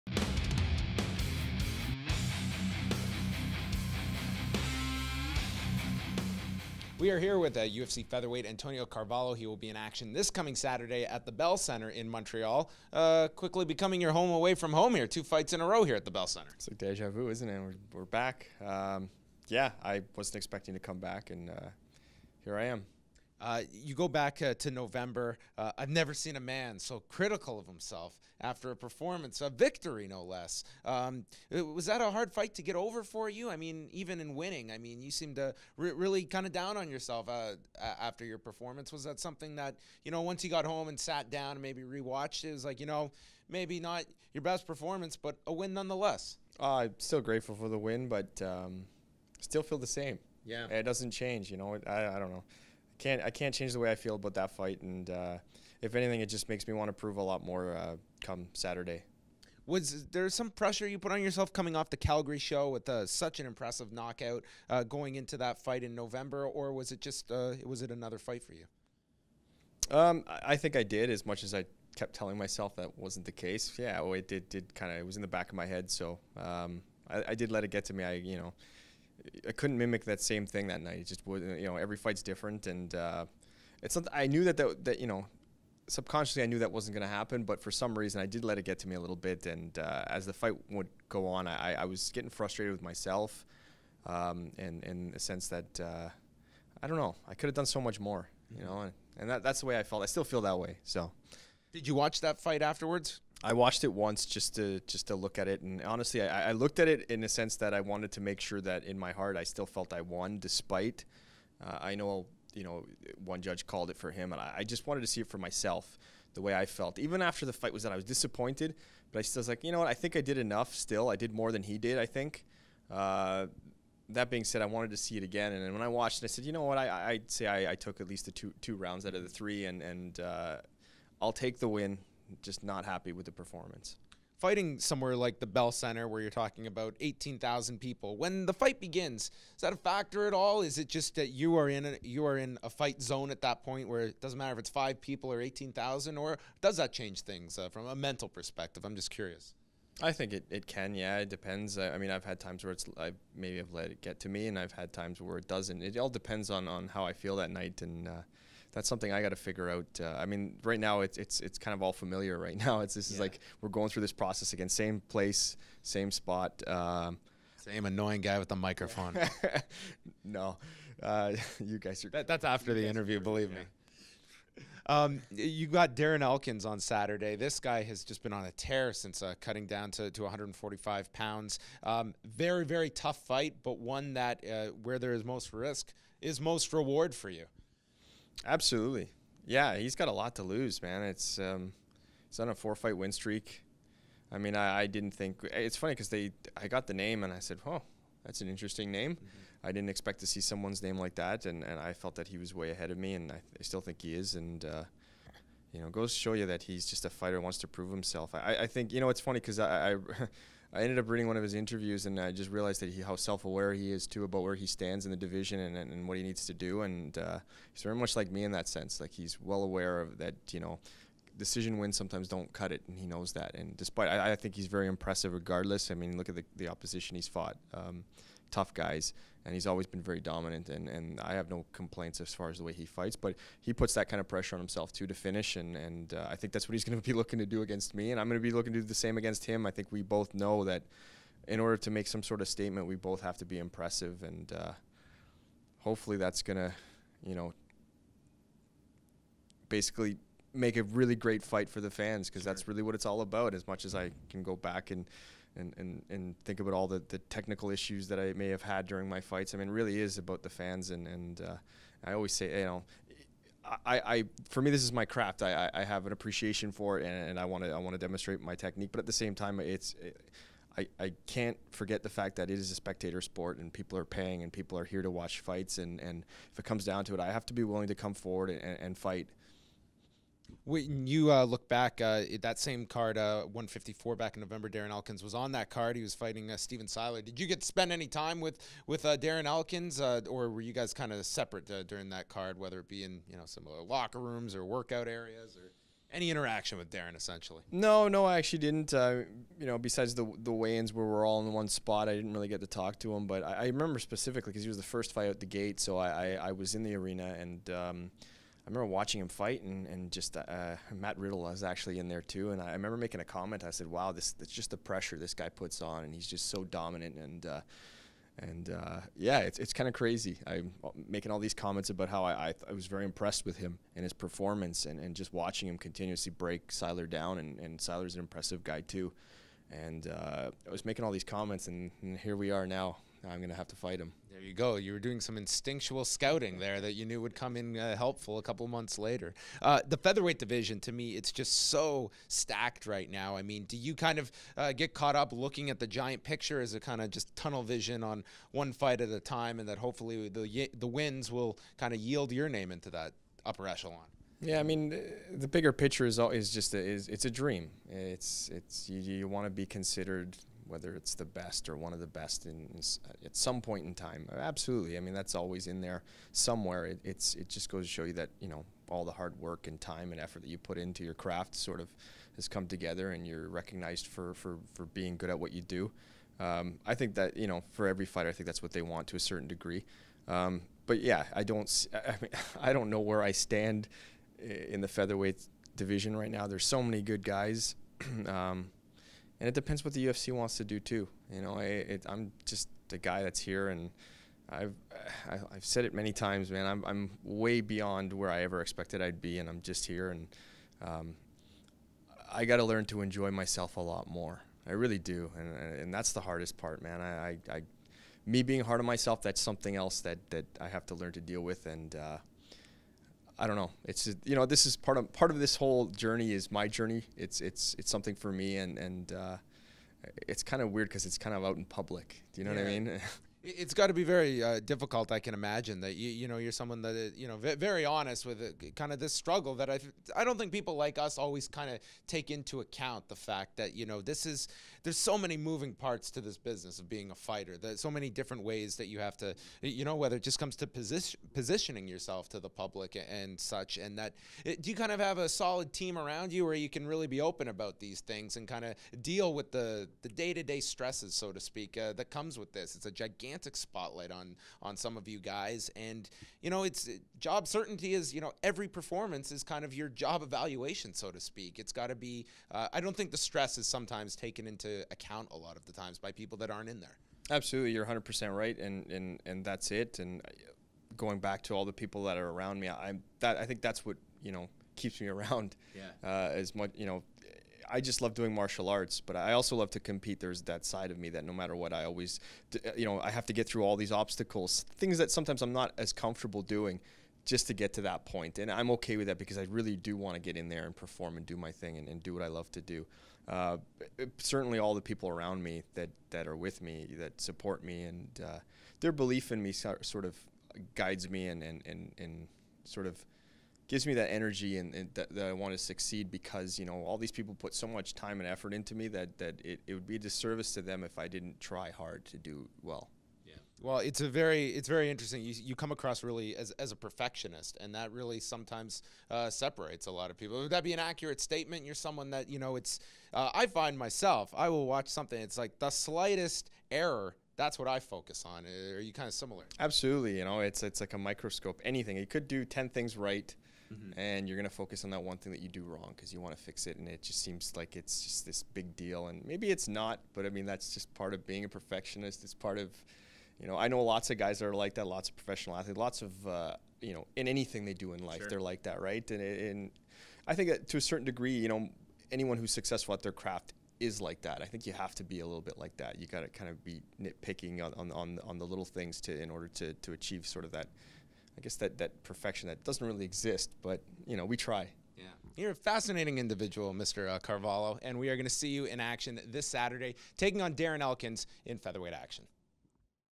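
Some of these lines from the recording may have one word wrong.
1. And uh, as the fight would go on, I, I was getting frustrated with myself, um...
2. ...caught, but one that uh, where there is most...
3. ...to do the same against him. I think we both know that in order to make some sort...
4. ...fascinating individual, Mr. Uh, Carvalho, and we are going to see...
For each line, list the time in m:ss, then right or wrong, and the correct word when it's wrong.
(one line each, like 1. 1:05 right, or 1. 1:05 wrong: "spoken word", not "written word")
1. 1:29 right
2. 3:03 wrong: "fight", not "caught"
3. 3:58 right
4. 9:25 right.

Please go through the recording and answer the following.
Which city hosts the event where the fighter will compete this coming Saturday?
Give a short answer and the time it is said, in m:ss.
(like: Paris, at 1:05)
Montreal, at 0:12.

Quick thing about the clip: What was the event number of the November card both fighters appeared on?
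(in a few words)
154.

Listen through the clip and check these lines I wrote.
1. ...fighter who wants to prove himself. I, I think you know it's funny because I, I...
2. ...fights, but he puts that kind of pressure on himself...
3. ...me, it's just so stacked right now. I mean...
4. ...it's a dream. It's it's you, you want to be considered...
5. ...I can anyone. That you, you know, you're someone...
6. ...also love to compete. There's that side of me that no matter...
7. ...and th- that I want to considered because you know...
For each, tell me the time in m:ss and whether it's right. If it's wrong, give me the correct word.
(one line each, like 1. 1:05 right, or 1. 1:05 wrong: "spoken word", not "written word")
1. 3:27 right
2. 3:52 right
3. 5:40 right
4. 5:57 right
5. 7:05 wrong: "imagine", not "anyone"
6. 7:59 right
7. 8:24 wrong: "succeed", not "considered".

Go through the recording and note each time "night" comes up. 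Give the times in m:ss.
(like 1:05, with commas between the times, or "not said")
1:20, 2:37.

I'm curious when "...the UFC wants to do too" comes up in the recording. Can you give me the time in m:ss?
6:29.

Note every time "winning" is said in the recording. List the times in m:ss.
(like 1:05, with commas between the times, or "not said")
0:34.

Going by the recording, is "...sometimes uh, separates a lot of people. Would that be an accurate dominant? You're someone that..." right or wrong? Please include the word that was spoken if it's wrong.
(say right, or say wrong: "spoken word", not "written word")
wrong: "statement", not "dominant".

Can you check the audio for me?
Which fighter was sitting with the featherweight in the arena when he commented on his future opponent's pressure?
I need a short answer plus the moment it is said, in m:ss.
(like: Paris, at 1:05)
Matt Riddle, at 5:10.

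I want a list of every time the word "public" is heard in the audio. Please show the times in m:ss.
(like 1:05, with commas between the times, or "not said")
7:01, 7:22.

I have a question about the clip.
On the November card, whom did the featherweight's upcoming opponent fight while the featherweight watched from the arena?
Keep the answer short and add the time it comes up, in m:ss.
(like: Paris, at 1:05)
Steven Siler, at 4:46.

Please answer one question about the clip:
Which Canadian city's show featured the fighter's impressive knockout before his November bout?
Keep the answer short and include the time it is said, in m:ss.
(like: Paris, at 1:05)
Calgary, at 1:01.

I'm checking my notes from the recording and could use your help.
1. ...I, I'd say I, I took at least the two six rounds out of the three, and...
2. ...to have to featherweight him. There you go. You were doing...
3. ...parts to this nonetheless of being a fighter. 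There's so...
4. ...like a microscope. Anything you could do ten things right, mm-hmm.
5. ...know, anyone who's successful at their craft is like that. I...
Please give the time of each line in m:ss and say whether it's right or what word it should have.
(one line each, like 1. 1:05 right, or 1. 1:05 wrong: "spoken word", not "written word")
1. 2:06 wrong: "two", not "six"
2. 5:33 wrong: "fight", not "featherweight"
3. 7:15 wrong: "business", not "nonetheless"
4. 8:50 right
5. 9:11 right.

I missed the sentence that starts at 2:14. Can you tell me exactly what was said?
Fighting somewhere like the Bell Center, where you're talking about 18,000 people, when the fight begins, is that a factor at all?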